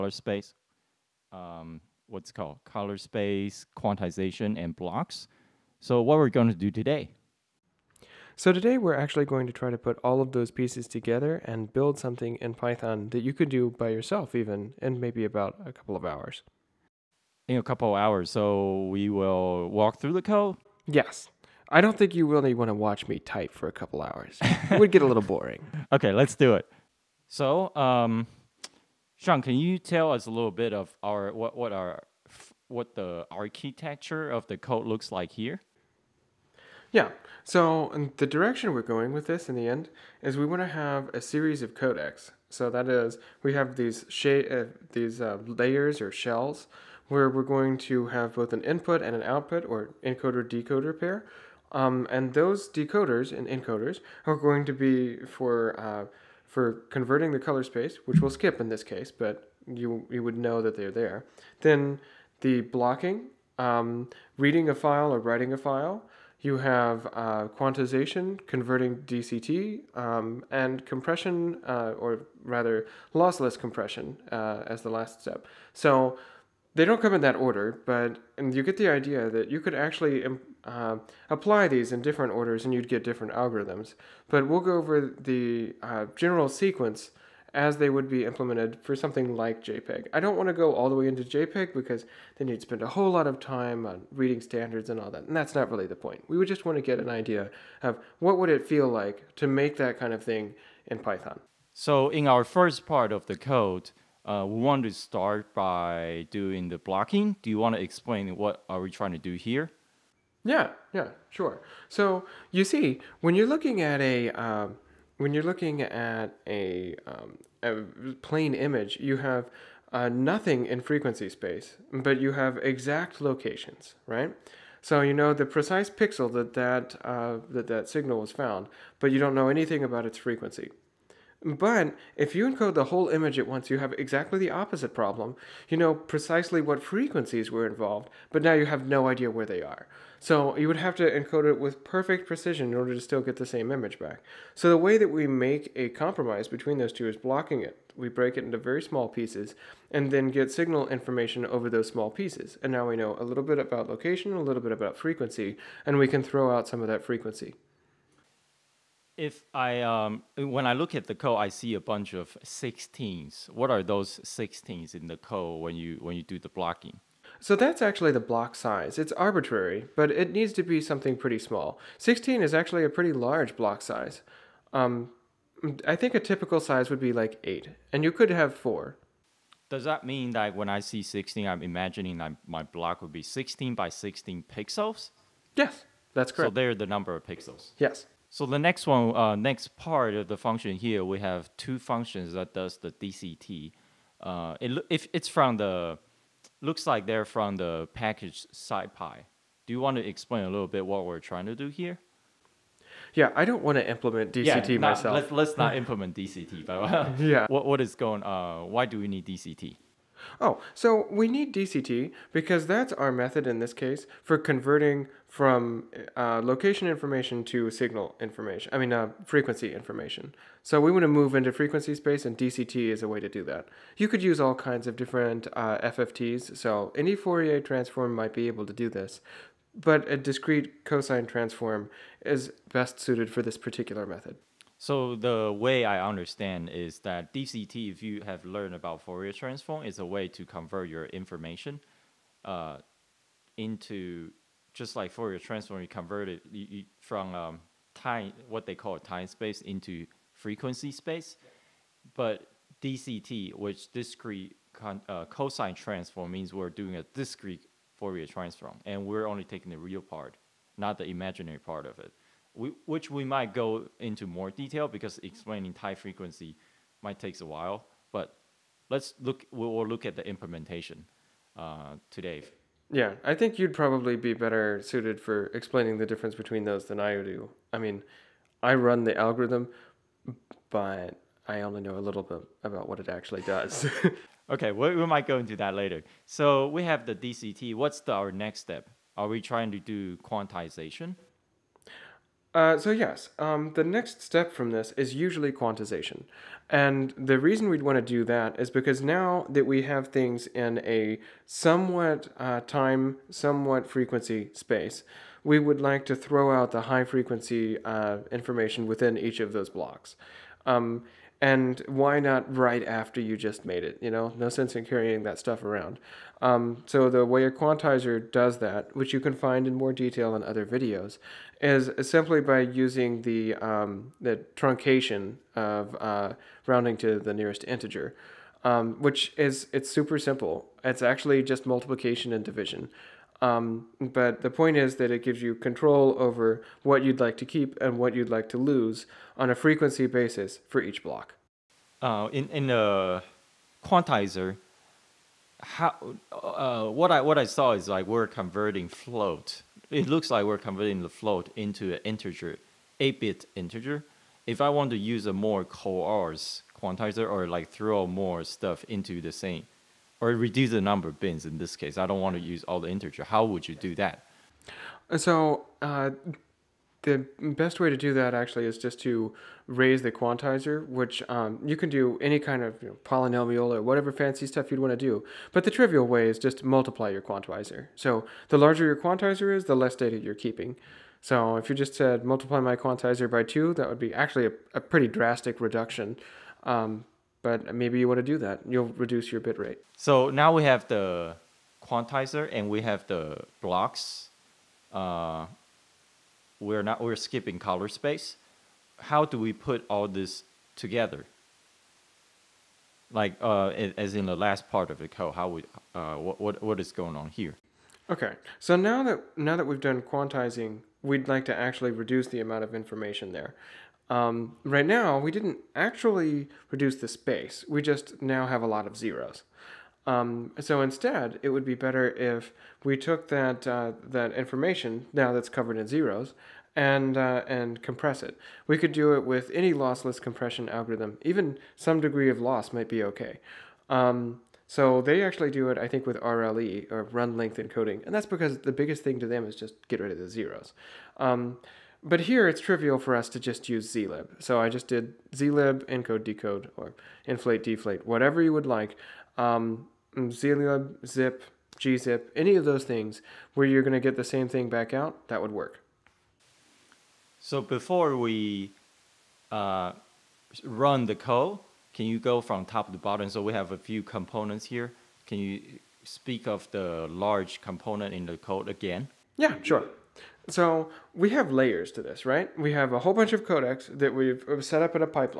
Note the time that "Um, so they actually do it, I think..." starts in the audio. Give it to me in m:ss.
7:13.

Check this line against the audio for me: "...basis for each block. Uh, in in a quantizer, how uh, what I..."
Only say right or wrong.
right.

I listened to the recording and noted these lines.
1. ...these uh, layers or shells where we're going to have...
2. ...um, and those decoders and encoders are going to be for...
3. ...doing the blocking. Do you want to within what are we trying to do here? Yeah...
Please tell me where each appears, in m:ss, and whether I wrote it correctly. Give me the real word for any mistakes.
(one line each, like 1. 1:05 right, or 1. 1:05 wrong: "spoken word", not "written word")
1. 0:44 right
2. 0:51 right
3. 1:46 wrong: "explain", not "within".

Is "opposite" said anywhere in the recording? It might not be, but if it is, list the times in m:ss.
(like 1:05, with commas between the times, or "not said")
2:14.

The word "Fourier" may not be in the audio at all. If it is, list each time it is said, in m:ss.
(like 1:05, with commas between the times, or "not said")
3:47, 3:59, 4:05, 4:17.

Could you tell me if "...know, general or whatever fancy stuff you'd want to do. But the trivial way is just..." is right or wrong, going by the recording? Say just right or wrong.
wrong.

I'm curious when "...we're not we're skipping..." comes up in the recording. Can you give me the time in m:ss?
6:36.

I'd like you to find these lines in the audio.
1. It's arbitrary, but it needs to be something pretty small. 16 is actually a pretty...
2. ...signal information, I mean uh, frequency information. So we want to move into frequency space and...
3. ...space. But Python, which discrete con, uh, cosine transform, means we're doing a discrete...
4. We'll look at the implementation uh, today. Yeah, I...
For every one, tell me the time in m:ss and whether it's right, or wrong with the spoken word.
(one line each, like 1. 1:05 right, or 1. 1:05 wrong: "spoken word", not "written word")
1. 2:48 right
2. 3:37 right
3. 4:10 wrong: "DCT", not "Python"
4. 4:29 right.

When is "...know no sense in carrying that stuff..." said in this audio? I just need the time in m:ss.
5:14.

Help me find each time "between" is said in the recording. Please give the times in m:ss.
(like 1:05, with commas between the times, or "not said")
2:26, 4:36.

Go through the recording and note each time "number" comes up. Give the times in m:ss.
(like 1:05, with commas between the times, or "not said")
3:06, 6:00.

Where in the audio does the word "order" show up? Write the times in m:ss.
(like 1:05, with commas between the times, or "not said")
1:17, 1:22, 2:22.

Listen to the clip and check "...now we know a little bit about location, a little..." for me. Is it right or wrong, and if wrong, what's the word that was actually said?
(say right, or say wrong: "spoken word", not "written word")
right.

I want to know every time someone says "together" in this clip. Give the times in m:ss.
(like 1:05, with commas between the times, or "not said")
0:10, 6:40.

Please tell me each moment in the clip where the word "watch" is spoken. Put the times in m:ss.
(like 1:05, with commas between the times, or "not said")
0:22.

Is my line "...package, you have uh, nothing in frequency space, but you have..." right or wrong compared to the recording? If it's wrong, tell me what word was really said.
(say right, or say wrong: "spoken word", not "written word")
wrong: "image", not "package".